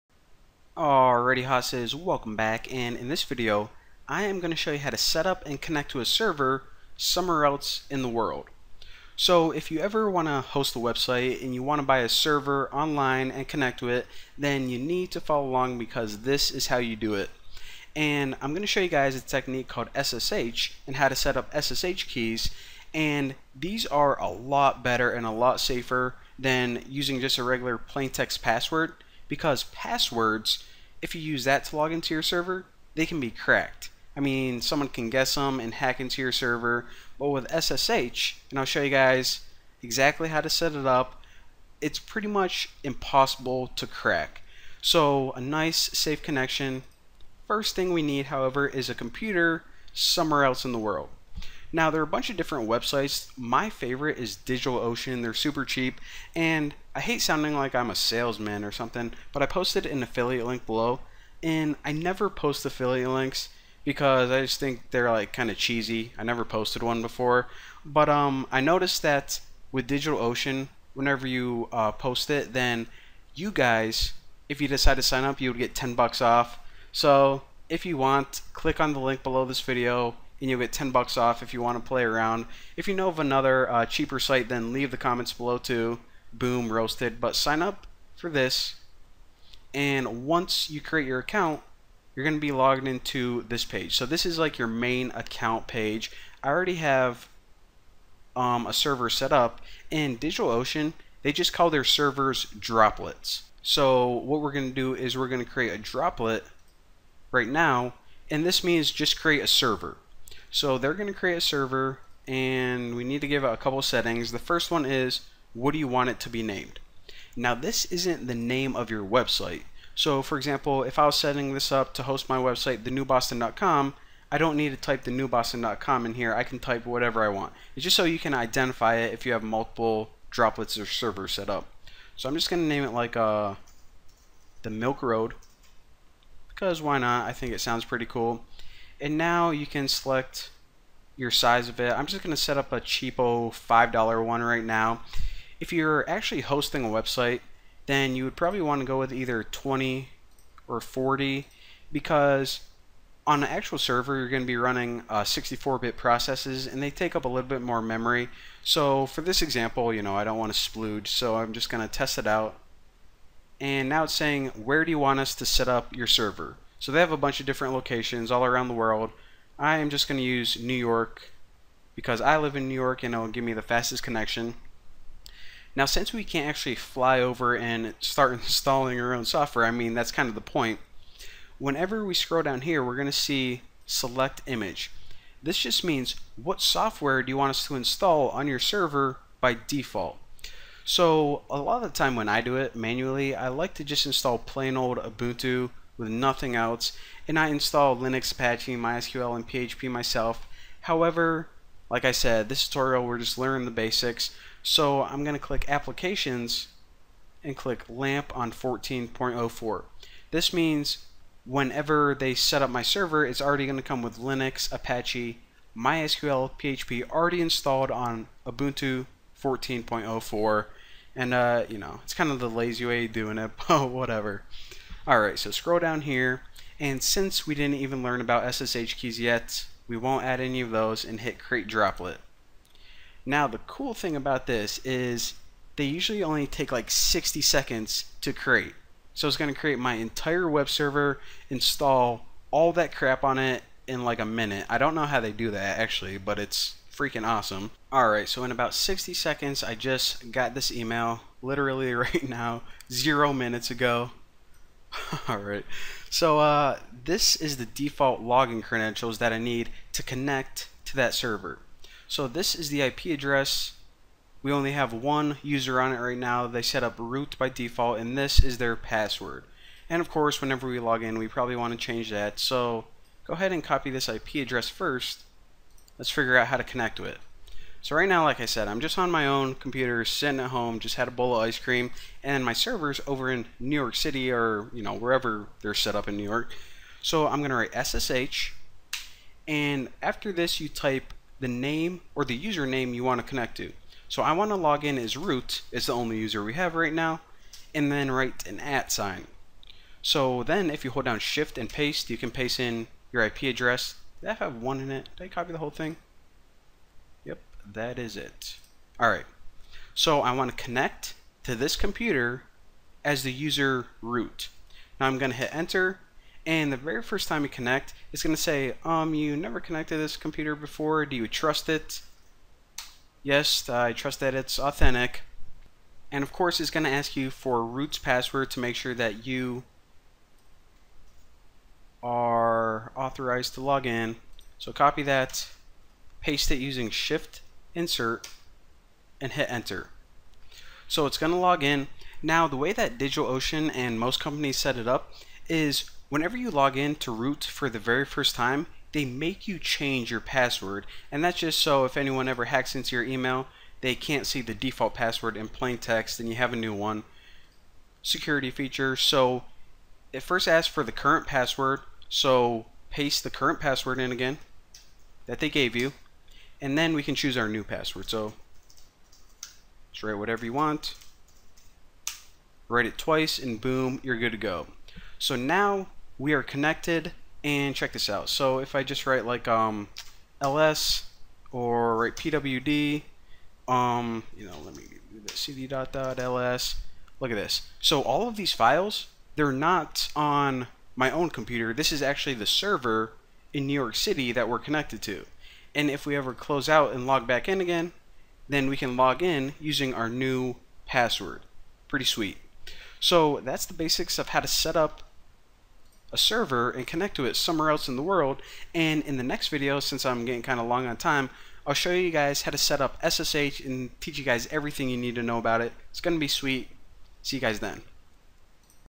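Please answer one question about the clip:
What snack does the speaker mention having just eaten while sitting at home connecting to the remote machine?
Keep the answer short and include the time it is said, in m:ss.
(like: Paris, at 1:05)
a bowl of ice cream, at 4:41.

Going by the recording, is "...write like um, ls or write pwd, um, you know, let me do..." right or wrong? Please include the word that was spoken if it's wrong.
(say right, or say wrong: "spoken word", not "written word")
right.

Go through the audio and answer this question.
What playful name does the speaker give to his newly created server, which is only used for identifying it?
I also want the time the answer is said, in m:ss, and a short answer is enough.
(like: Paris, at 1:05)
the Milk Road, at 2:14.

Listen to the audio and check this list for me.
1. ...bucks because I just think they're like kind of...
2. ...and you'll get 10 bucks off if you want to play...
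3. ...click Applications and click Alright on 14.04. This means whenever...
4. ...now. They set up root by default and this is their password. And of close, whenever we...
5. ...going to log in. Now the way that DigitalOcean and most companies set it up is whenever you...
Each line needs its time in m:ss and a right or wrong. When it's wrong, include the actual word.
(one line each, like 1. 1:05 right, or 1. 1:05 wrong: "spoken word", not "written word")
1. 1:03 wrong: "links", not "bucks"
2. 1:20 right
3. 3:25 wrong: "LAMP", not "Alright"
4. 4:26 wrong: "course", not "close"
5. 5:41 right.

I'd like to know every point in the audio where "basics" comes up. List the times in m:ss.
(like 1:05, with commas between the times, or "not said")
3:23, 6:43.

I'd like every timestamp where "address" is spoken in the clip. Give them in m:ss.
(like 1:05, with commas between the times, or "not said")
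4:23, 4:34, 5:03.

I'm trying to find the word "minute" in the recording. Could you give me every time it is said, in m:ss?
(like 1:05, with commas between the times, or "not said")
4:04, 4:13.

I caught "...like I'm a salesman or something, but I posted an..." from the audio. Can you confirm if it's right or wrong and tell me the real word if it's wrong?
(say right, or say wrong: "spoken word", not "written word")
right.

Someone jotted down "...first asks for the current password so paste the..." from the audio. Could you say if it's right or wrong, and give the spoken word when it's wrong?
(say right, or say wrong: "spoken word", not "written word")
right.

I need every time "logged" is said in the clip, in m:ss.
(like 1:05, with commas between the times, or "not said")
1:32.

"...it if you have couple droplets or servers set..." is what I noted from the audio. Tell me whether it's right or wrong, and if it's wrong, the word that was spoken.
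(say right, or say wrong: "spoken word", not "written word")
wrong: "multiple", not "couple".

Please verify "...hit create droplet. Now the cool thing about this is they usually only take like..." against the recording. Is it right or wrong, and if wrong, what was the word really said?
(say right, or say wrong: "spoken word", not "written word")
right.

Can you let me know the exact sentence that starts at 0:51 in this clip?
Now, there are a bunch of different websites.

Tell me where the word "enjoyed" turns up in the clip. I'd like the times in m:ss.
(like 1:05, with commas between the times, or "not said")
not said.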